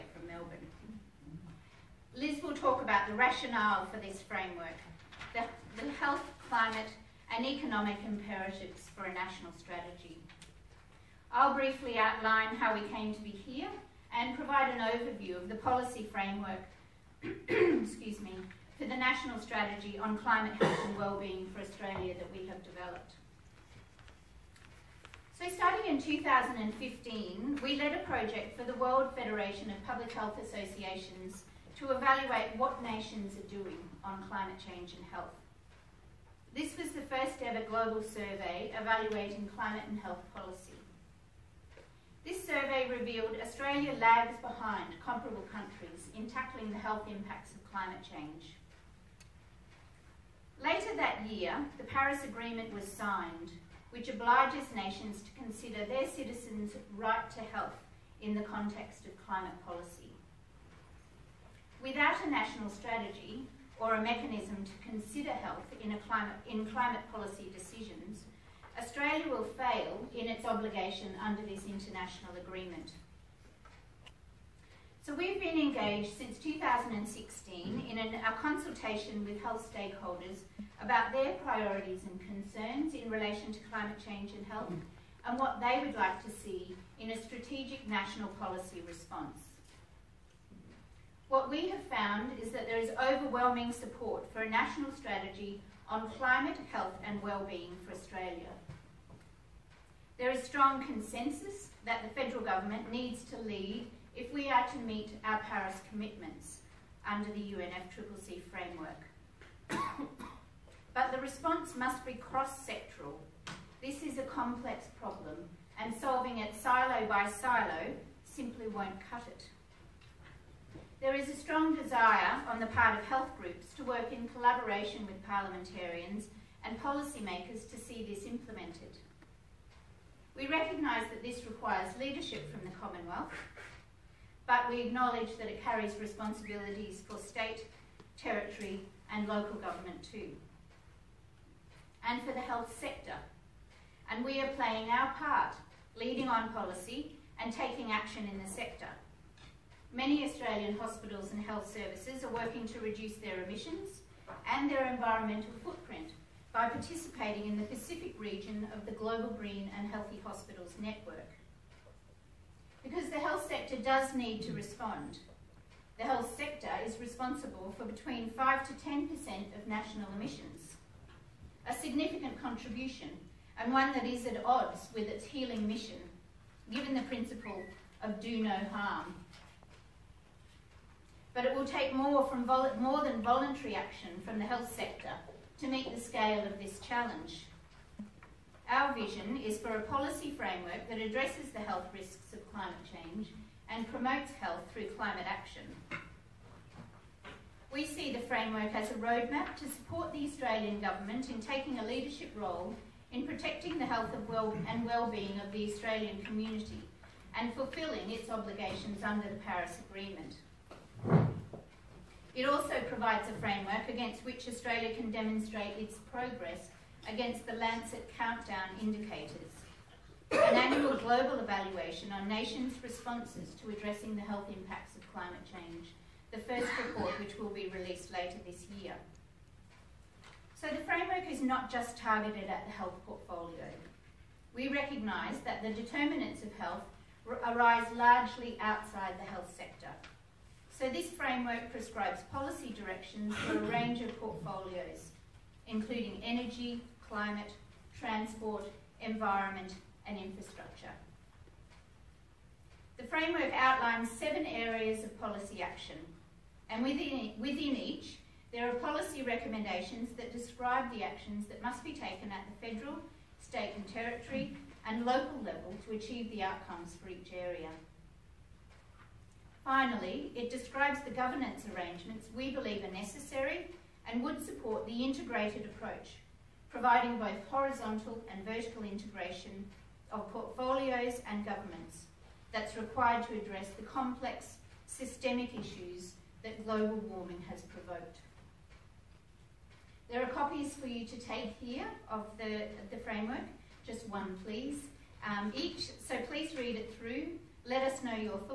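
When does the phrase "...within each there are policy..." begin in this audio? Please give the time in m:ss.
4:17.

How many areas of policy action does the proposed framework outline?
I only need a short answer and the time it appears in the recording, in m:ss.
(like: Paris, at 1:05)
7, at 4:14.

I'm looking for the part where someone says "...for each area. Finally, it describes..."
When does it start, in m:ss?
4:27.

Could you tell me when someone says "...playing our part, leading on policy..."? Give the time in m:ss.
2:24.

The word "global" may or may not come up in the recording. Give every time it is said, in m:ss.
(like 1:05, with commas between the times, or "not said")
0:37, 2:38, 3:40, 4:46.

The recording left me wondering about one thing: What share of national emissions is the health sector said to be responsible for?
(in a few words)
5 to 10%.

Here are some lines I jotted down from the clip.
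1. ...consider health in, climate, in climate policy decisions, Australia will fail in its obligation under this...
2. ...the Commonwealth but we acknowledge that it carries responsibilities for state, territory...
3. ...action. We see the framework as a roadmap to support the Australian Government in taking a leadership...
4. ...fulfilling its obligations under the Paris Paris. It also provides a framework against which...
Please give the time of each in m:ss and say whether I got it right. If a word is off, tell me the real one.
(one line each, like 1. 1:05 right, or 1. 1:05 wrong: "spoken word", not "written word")
1. 1:04 right
2. 2:12 right
3. 3:15 right
4. 3:27 wrong: "Agreement", not "Paris".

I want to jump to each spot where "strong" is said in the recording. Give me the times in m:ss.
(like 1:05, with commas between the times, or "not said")
1:40, 2:01.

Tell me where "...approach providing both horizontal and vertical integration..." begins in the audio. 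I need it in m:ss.
4:35.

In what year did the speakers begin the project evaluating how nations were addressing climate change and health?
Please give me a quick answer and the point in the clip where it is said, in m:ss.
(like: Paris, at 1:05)
2015, at 0:26.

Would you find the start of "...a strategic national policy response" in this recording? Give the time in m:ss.
1:27.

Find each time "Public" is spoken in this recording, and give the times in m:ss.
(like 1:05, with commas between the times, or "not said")
0:29.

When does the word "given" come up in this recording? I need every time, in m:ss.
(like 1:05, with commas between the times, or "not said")
2:56.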